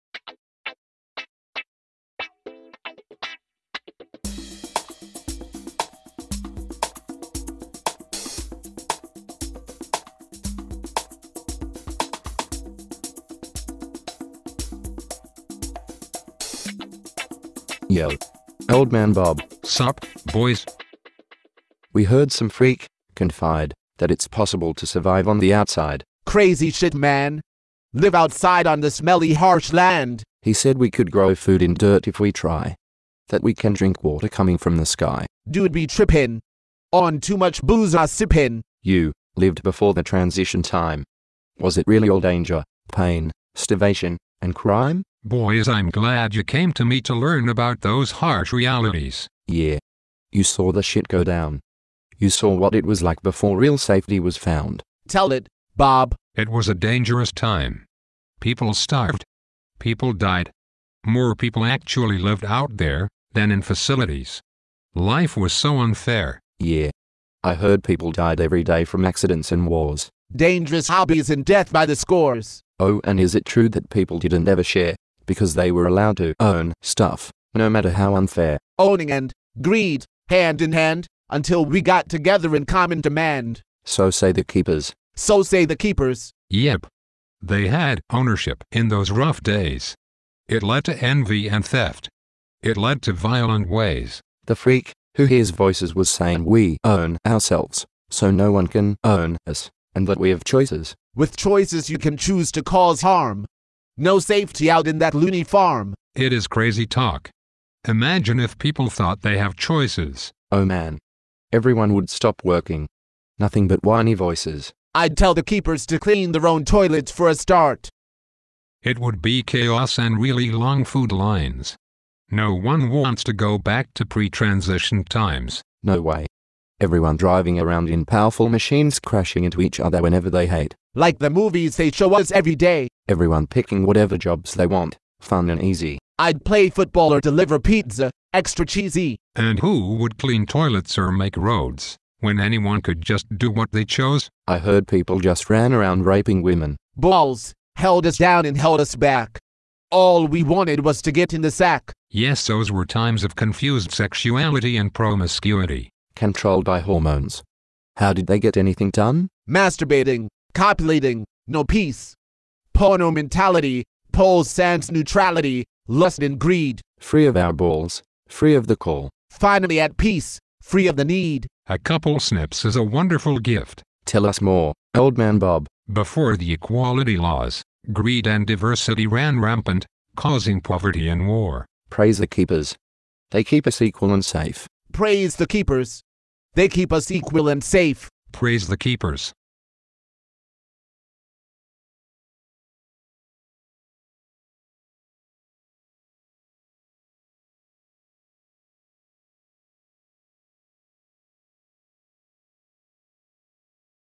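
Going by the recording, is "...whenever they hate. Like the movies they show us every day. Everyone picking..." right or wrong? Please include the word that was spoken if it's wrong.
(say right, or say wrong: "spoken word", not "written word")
right.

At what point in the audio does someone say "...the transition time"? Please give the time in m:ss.
0:39.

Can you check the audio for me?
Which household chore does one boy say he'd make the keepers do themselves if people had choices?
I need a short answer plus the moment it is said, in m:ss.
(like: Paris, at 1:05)
clean toilets, at 1:55.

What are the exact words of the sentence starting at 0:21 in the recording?
We heard some freak confide that it's possible to survive on the outside.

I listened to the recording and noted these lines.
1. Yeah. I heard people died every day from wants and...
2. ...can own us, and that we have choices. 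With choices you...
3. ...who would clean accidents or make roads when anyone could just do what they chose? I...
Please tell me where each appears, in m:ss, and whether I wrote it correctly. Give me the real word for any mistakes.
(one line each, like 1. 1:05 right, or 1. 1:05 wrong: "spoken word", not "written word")
1. 1:06 wrong: "accidents", not "wants"
2. 1:38 right
3. 2:19 wrong: "toilets", not "accidents".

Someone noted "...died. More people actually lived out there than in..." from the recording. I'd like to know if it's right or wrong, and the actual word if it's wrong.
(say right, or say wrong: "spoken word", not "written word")
right.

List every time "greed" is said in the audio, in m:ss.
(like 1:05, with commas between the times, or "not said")
1:19, 2:46, 2:57.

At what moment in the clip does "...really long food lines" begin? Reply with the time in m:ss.
2:00.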